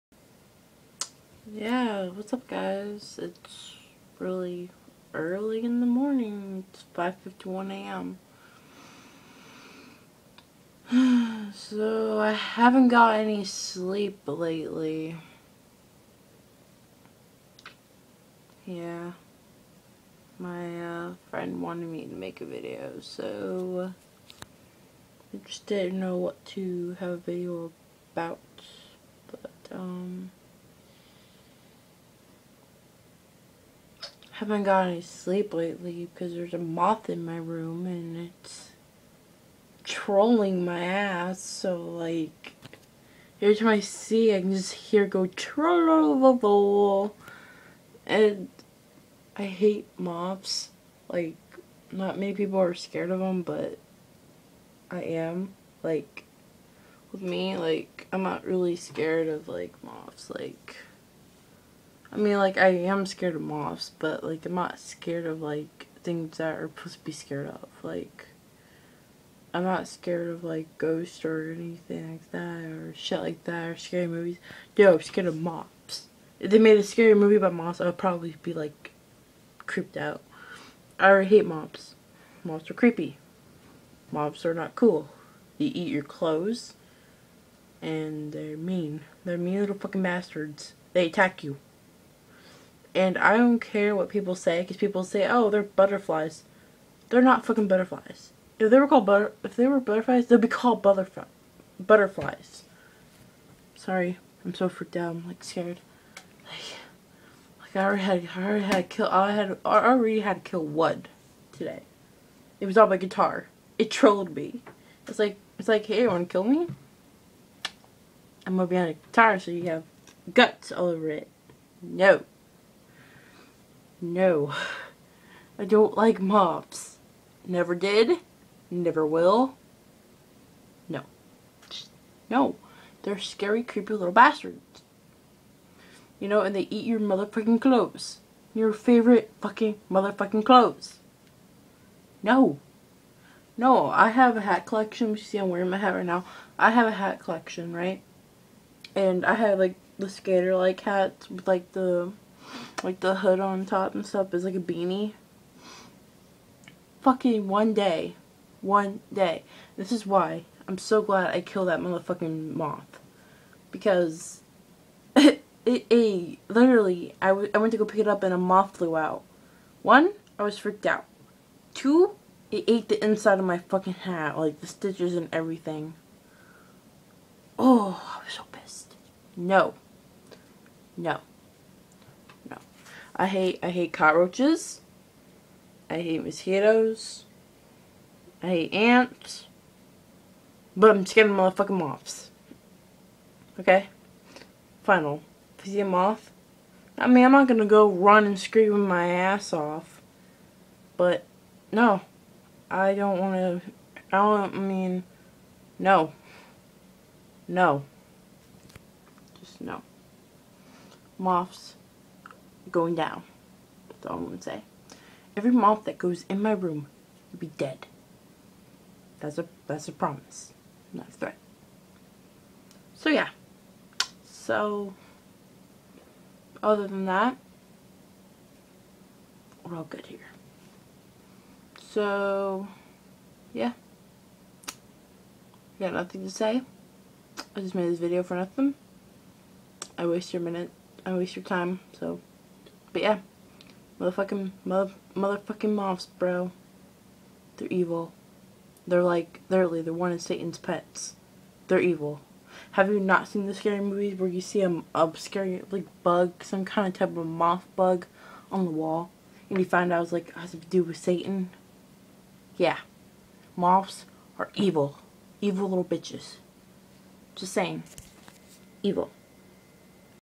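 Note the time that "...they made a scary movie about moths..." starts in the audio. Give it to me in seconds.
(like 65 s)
76 s.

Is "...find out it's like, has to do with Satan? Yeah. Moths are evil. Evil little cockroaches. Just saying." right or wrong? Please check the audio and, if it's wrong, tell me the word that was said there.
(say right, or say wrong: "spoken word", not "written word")
wrong: "bitches", not "cockroaches".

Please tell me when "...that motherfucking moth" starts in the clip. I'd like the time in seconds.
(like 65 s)
161 s.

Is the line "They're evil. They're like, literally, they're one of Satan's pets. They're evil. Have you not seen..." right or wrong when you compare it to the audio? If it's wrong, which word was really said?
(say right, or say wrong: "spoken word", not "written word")
right.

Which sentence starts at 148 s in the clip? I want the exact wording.
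And I have, like, the skater-like hats with, like, the like the hood on top and stuff is like a beanie.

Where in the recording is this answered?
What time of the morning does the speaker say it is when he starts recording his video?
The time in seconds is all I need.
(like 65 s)
6 s.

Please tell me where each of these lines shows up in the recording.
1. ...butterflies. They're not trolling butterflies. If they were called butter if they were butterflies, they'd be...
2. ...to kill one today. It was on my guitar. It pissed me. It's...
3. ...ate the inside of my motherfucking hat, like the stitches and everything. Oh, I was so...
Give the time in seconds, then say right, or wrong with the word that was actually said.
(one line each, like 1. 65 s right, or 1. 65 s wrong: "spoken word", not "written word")
1. 95 s wrong: "fucking", not "trolling"
2. 110 s wrong: "trolled", not "pissed"
3. 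172 s wrong: "fucking", not "motherfucking".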